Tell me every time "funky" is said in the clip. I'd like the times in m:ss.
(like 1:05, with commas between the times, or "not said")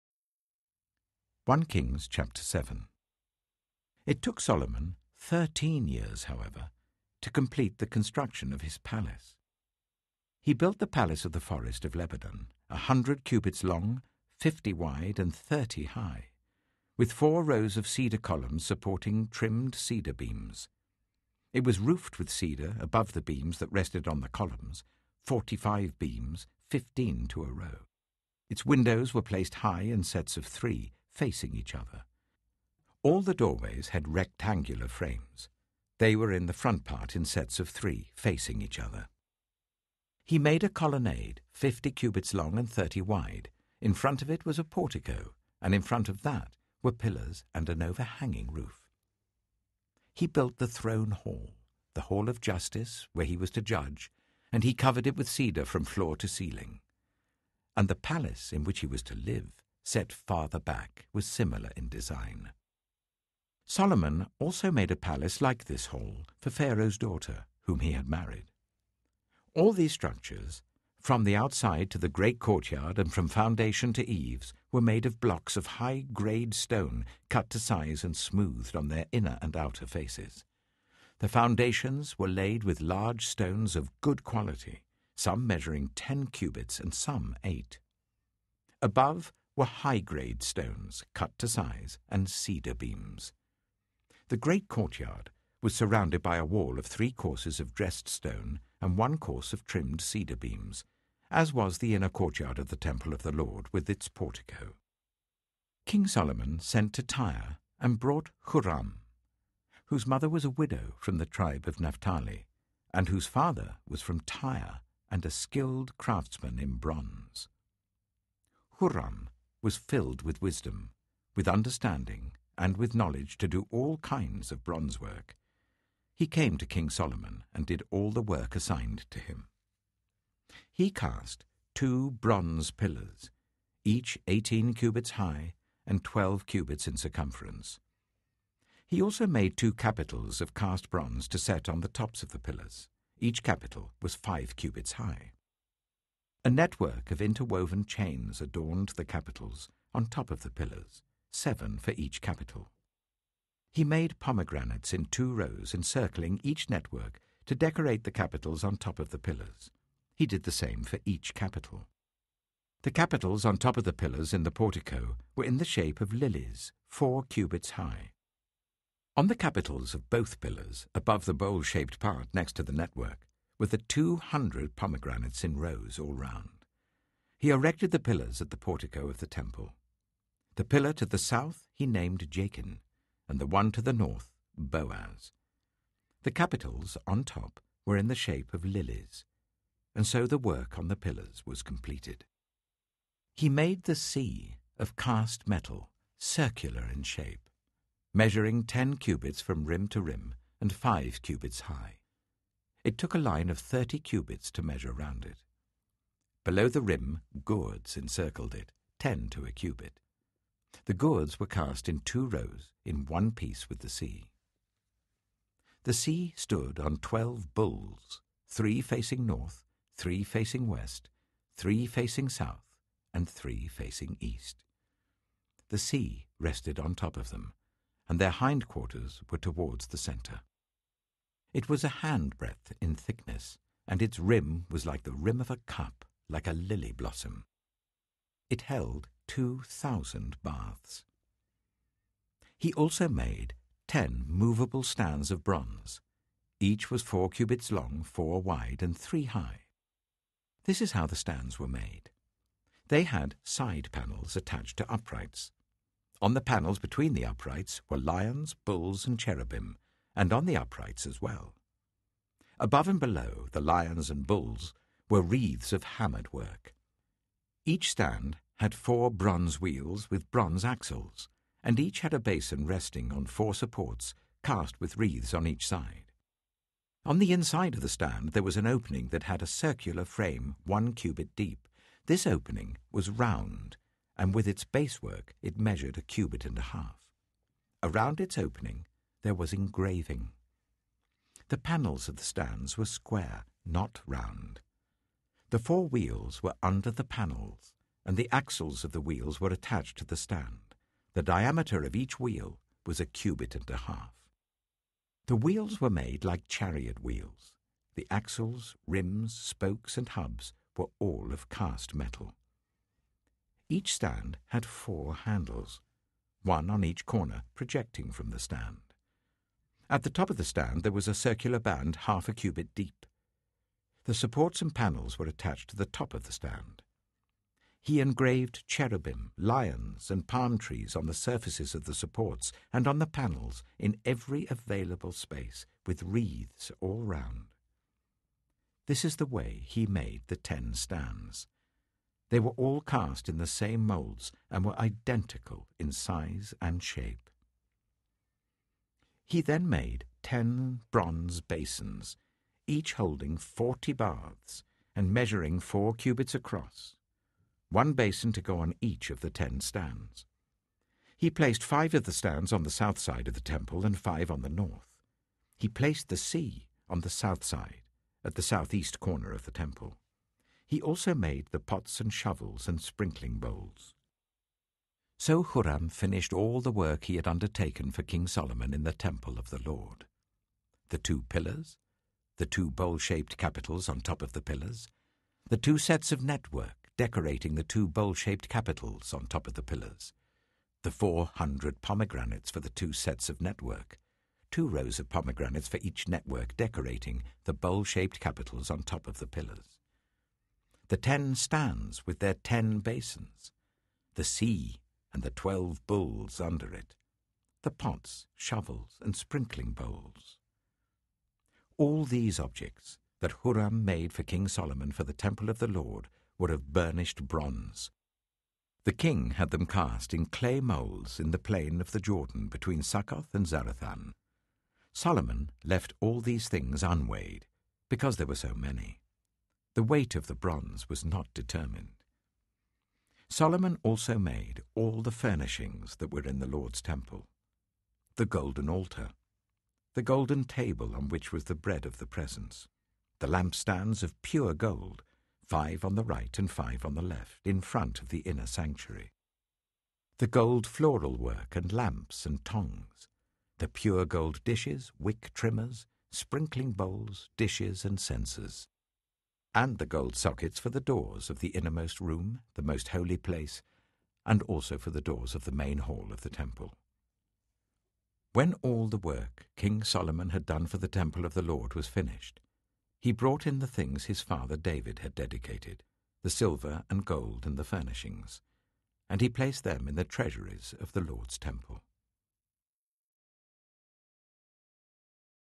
not said.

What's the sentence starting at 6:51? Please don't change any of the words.
All these objects that Huram made for King Solomon for the temple of the Lord were of burnished bronze.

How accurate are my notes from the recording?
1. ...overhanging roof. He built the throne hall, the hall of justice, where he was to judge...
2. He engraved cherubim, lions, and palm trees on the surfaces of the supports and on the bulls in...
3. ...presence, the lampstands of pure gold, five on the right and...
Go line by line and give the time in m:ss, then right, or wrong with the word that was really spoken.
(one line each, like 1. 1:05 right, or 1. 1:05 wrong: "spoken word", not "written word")
1. 0:47 right
2. 5:27 wrong: "panels", not "bulls"
3. 7:22 right.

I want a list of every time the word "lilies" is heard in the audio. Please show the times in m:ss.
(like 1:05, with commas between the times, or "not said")
2:46, 3:08.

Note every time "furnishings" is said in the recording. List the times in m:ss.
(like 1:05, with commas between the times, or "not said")
7:15, 7:57.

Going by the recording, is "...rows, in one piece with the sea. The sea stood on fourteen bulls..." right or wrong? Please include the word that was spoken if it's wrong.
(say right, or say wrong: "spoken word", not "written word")
wrong: "twelve", not "fourteen".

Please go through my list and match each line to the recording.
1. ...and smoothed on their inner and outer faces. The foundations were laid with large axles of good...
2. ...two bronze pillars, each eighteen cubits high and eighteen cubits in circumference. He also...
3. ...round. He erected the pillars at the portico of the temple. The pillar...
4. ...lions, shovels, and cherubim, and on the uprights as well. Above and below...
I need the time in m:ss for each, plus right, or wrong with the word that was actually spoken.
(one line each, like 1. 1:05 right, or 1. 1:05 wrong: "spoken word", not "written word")
1. 1:18 wrong: "stones", not "axles"
2. 2:11 wrong: "twelve", not "eighteen"
3. 2:56 right
4. 4:17 wrong: "bulls", not "shovels".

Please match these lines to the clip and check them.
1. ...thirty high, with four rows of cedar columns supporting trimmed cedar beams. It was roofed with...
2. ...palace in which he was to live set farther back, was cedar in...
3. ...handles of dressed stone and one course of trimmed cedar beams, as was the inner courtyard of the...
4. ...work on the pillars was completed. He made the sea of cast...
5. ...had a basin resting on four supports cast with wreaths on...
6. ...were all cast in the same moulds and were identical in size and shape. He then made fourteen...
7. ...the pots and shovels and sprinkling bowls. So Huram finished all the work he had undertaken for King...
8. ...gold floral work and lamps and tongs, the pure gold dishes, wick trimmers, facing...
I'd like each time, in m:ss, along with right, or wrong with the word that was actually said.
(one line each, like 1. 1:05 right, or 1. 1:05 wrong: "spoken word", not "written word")
1. 0:15 right
2. 0:57 wrong: "similar", not "cedar"
3. 1:37 wrong: "courses", not "handles"
4. 3:10 right
5. 4:32 right
6. 5:42 wrong: "ten", not "fourteen"
7. 6:11 right
8. 7:30 wrong: "sprinkling", not "facing".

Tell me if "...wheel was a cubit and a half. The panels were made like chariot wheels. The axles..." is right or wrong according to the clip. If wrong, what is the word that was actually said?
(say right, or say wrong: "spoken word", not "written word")
wrong: "wheels", not "panels".